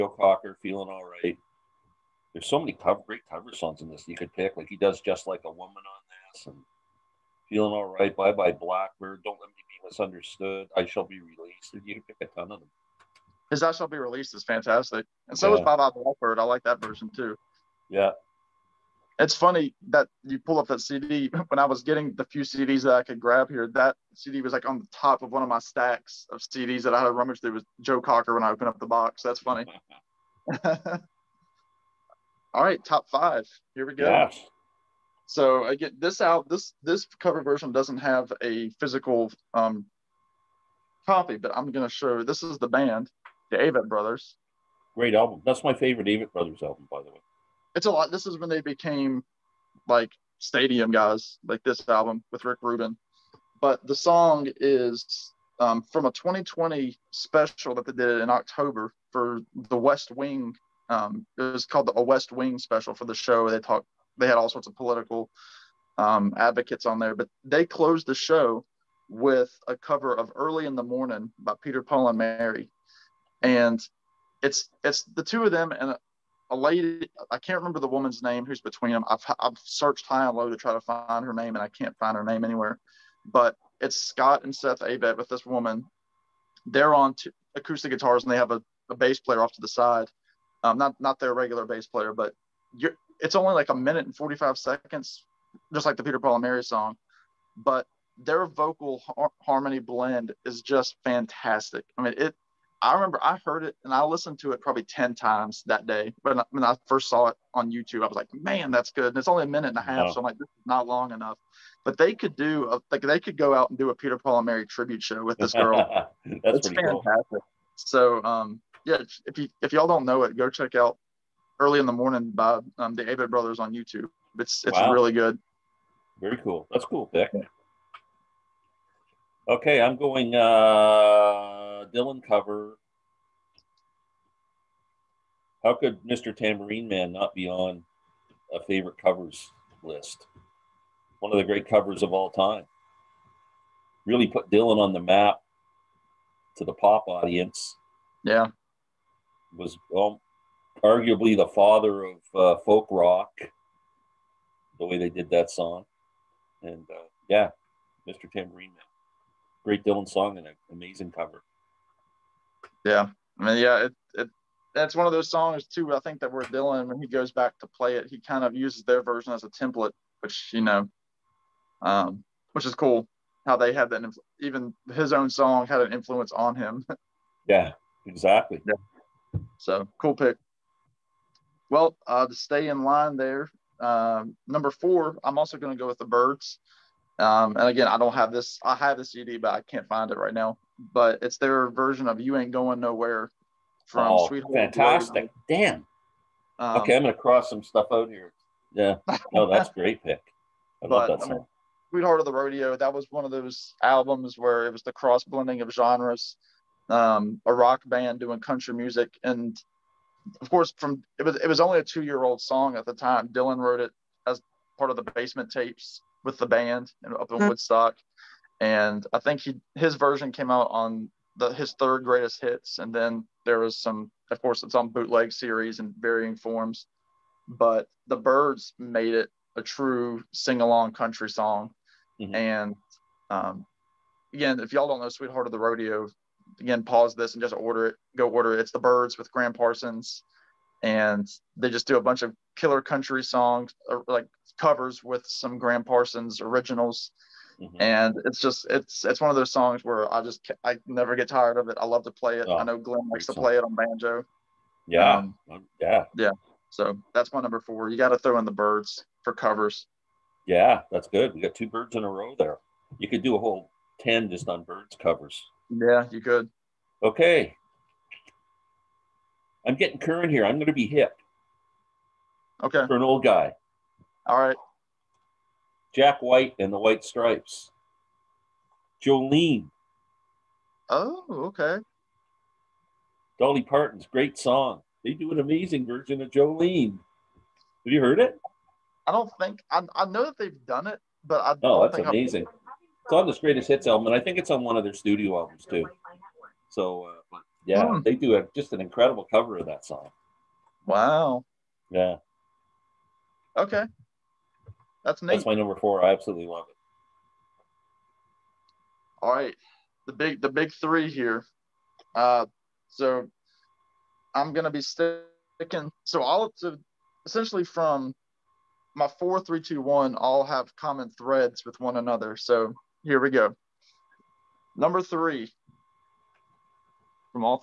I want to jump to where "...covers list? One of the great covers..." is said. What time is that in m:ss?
2:18.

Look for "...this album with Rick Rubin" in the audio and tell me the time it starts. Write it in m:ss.
0:51.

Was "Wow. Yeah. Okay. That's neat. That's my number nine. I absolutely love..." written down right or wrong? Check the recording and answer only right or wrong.
wrong.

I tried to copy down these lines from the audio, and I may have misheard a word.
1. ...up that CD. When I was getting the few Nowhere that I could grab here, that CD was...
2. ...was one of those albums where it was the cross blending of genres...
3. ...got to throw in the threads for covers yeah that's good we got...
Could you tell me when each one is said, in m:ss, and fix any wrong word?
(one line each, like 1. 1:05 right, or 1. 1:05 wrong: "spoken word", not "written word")
1. 0:20 wrong: "CDs", not "Nowhere"
2. 3:22 right
3. 4:17 wrong: "byrds", not "threads".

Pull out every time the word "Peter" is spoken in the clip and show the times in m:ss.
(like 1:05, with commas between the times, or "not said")
1:11, 1:36, 1:53.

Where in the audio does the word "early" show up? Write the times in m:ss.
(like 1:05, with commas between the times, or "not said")
1:10, 2:01.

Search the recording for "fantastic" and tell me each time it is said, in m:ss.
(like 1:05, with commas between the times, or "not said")
0:14, 1:41, 1:56, 3:14.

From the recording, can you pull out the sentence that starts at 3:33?
Dylan wrote it as part of the basement tapes with the band up in mm-hmm.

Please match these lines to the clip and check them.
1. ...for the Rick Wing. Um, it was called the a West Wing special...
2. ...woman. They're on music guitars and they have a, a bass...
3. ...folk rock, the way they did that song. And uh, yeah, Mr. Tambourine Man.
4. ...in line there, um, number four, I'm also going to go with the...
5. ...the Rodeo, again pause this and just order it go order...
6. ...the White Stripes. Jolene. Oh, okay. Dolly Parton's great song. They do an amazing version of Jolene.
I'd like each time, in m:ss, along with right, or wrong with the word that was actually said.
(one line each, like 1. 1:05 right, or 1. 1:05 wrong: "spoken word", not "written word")
1. 0:59 wrong: "West", not "Rick"
2. 1:25 wrong: "acoustic", not "music"
3. 2:32 right
4. 3:02 right
5. 3:55 right
6. 4:36 right.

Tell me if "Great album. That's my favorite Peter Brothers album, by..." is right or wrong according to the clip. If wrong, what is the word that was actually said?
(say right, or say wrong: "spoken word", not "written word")
wrong: "Avett", not "Peter".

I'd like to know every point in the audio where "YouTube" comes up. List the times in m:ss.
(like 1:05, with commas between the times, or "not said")
1:47, 2:03.